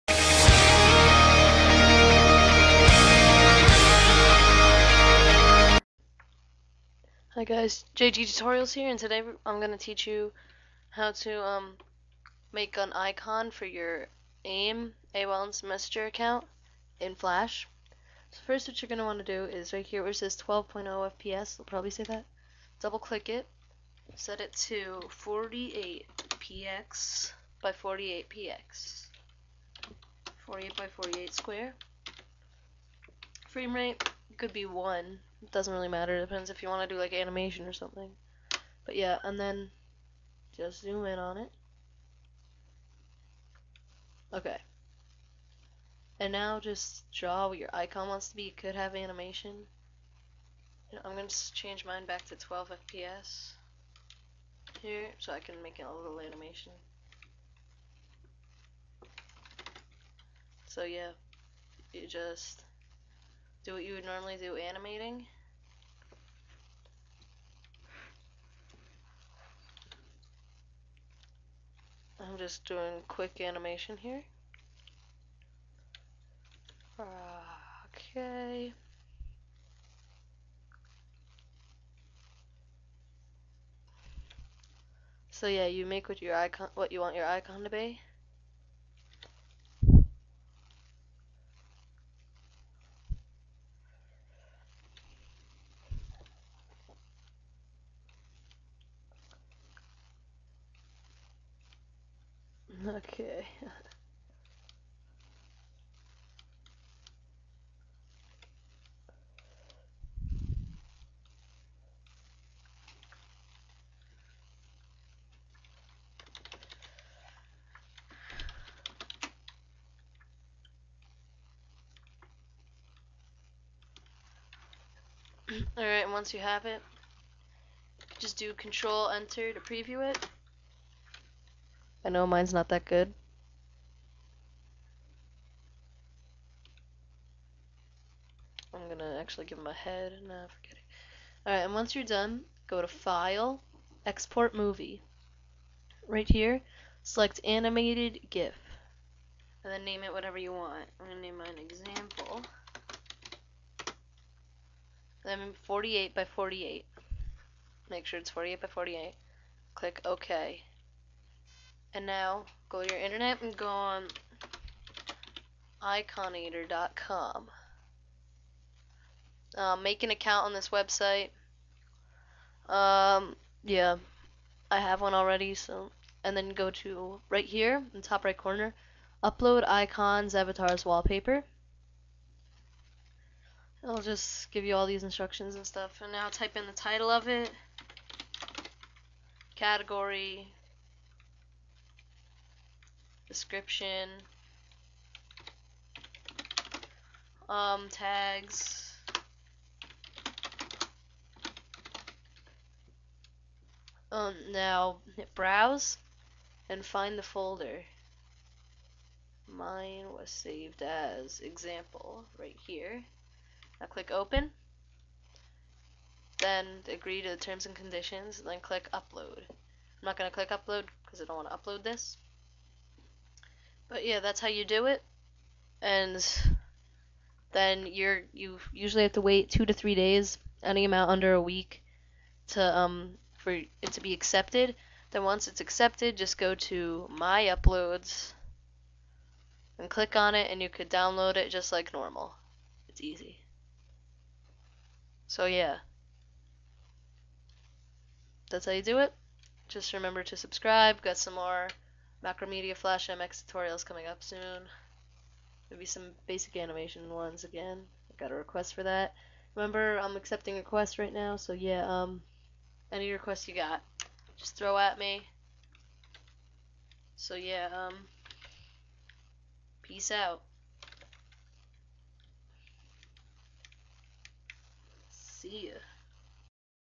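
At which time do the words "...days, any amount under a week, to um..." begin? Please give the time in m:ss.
3:49.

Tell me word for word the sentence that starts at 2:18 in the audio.
I'm gonna actually give him a head.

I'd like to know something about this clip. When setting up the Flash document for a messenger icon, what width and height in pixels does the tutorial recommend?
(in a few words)
48 by 48.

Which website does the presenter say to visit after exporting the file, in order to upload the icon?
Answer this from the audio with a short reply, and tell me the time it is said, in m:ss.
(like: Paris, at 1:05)
iconator.com, at 2:45.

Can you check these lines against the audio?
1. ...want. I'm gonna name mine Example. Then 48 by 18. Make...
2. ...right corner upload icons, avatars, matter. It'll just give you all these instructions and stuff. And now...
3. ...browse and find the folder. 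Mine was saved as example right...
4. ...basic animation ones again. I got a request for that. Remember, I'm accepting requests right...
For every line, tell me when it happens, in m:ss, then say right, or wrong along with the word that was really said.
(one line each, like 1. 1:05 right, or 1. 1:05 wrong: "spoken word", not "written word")
1. 2:30 wrong: "48", not "18"
2. 2:58 wrong: "wallpaper", not "matter"
3. 3:25 right
4. 4:16 right.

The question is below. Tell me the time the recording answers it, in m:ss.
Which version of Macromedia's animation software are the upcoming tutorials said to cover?
4:12.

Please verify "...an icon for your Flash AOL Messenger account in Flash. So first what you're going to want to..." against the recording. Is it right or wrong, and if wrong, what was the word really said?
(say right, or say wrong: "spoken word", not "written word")
wrong: "AIM", not "Flash".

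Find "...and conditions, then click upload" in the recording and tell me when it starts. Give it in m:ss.
3:37.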